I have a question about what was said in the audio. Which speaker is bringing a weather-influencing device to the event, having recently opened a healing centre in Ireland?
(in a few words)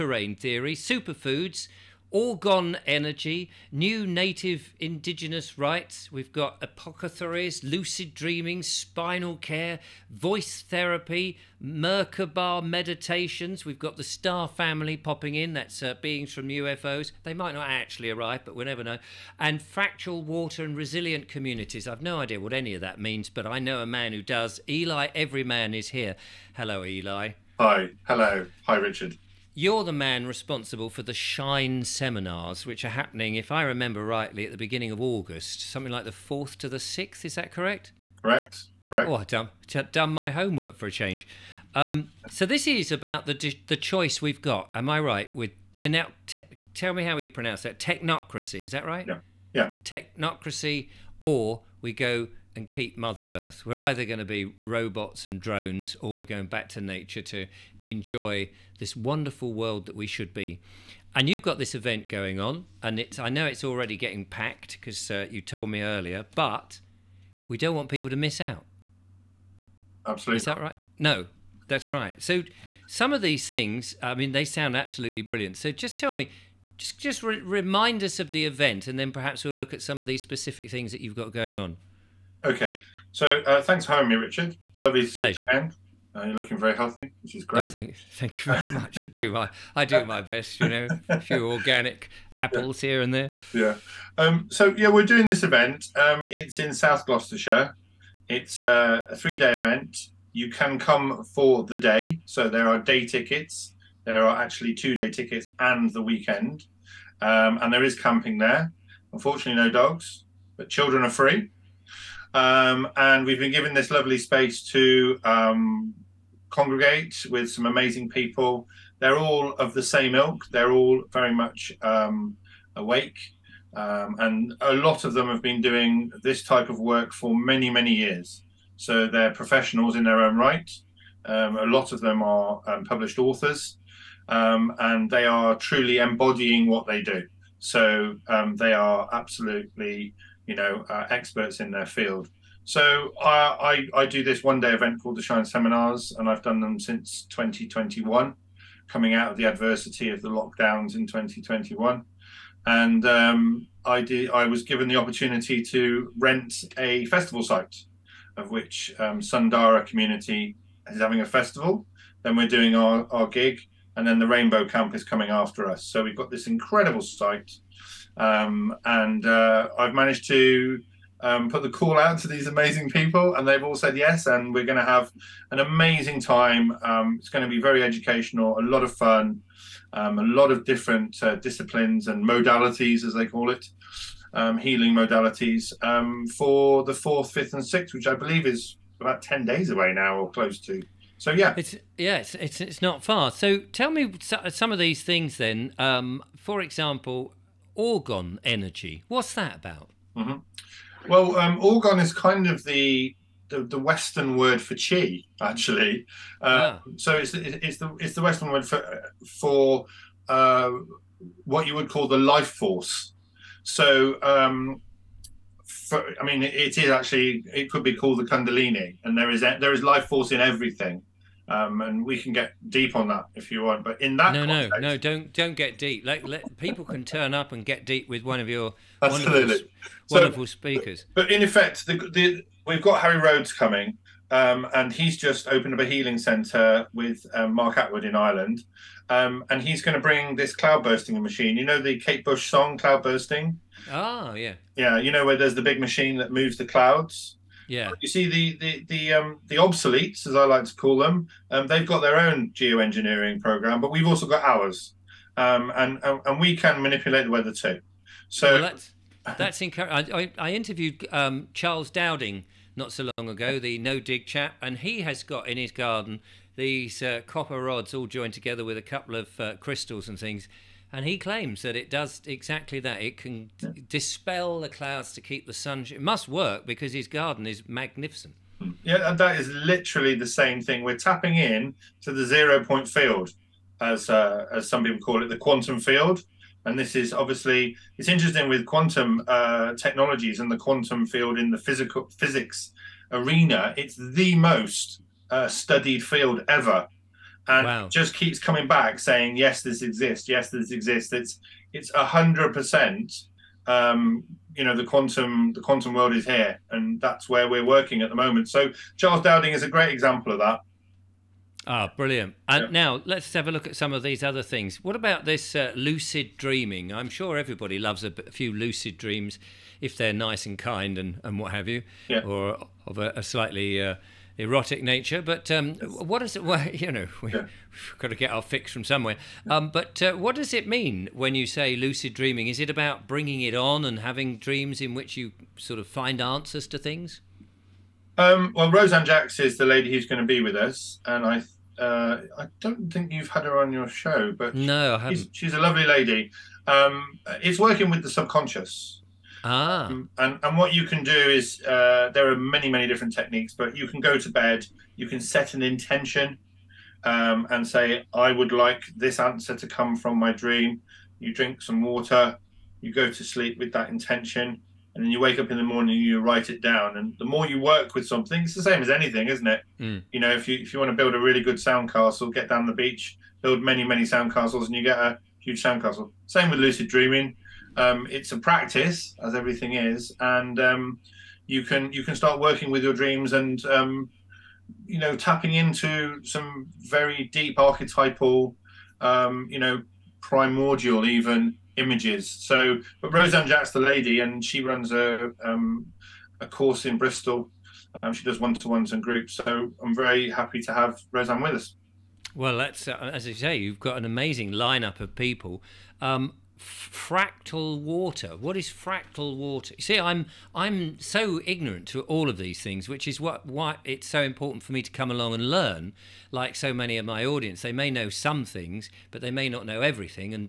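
Harry Rhodes.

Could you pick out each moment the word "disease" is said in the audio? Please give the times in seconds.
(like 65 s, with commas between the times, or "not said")
not said.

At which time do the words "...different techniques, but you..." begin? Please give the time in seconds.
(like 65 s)
352 s.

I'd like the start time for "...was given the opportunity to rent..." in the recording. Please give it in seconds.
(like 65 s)
154 s.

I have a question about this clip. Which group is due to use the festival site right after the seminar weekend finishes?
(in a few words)
Rainbow Camp.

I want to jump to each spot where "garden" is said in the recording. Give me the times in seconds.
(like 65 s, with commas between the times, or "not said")
265 s, 277 s.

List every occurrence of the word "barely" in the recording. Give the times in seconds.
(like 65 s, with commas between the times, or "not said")
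not said.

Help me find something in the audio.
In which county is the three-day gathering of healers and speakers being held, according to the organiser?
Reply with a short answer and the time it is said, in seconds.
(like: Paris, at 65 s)
South Gloucestershire, at 96 s.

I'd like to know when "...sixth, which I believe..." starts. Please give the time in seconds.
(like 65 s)
187 s.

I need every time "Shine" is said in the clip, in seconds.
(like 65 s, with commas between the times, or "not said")
31 s, 145 s.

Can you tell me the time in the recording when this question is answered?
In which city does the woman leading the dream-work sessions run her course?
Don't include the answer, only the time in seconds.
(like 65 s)
396 s.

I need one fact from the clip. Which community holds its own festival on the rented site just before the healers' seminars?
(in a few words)
Sundara.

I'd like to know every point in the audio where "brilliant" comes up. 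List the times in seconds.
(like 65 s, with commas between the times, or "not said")
75 s, 311 s.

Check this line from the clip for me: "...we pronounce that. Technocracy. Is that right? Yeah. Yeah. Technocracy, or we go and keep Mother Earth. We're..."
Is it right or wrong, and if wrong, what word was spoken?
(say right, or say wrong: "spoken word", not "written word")
right.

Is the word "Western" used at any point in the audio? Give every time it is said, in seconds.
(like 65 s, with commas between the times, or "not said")
203 s, 208 s.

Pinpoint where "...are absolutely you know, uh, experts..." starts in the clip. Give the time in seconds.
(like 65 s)
138 s.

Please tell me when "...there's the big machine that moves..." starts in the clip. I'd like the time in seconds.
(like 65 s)
245 s.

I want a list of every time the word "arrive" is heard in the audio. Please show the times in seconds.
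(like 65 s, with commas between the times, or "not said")
18 s.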